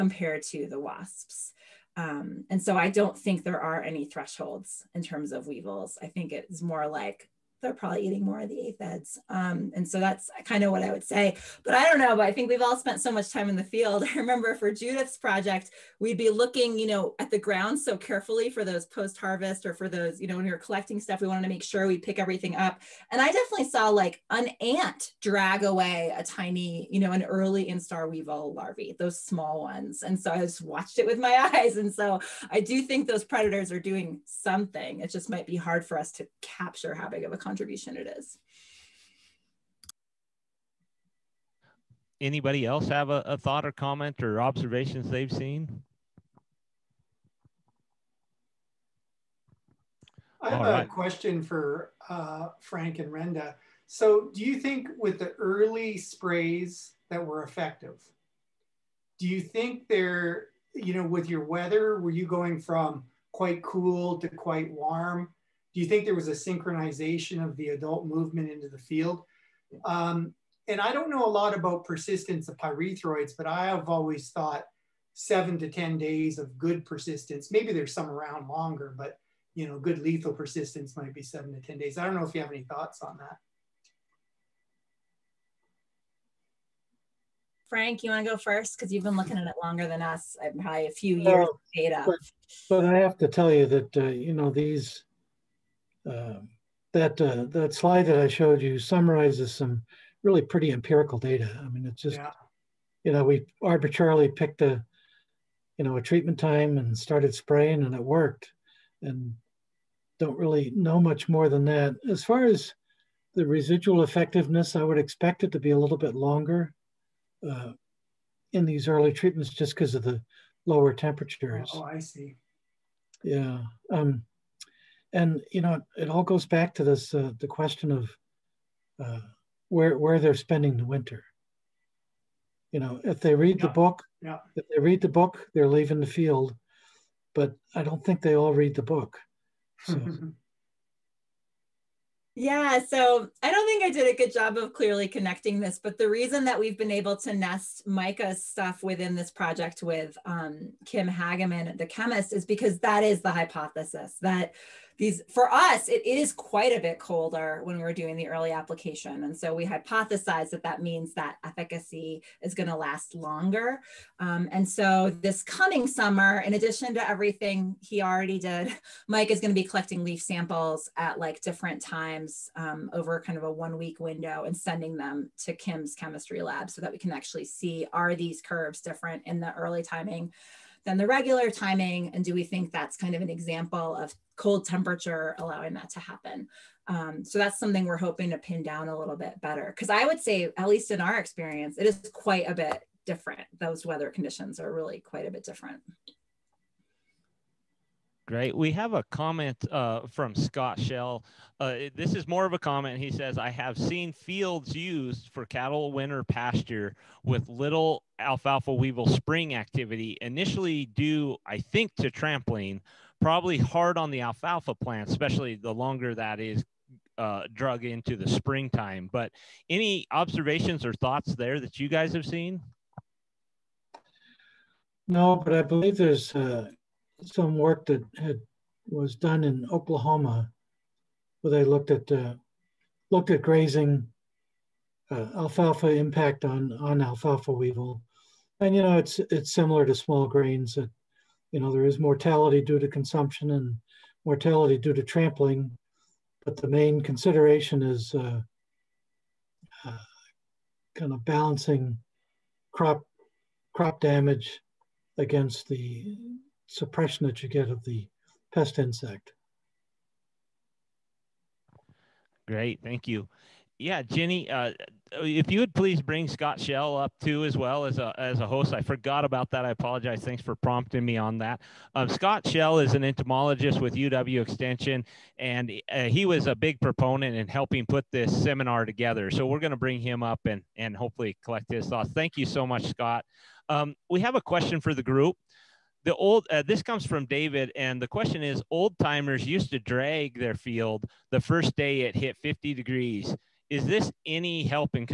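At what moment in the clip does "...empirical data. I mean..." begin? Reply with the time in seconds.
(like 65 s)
100 s.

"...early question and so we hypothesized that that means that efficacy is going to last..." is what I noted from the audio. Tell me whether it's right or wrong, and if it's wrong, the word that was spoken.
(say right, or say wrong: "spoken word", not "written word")
wrong: "application", not "question".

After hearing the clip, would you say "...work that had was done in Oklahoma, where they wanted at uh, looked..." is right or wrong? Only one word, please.
wrong.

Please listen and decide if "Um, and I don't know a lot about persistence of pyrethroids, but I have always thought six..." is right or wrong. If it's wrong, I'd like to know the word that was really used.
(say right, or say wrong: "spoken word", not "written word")
wrong: "seven", not "six".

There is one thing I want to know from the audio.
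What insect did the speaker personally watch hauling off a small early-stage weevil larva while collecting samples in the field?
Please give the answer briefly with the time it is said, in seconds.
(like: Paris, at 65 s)
An ant, at 24 s.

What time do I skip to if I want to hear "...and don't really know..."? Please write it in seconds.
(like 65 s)
109 s.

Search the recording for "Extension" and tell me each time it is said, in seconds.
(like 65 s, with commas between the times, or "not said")
274 s.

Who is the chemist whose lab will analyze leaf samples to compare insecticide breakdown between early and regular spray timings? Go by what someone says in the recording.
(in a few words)
Kim Hageman.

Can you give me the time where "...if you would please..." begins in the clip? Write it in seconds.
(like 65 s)
265 s.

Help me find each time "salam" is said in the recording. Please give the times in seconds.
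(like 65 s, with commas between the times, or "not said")
not said.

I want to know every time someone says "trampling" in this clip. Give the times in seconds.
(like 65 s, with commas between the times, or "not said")
212 s, 245 s.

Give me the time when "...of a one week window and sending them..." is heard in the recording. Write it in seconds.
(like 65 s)
173 s.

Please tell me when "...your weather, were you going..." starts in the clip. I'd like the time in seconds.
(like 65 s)
61 s.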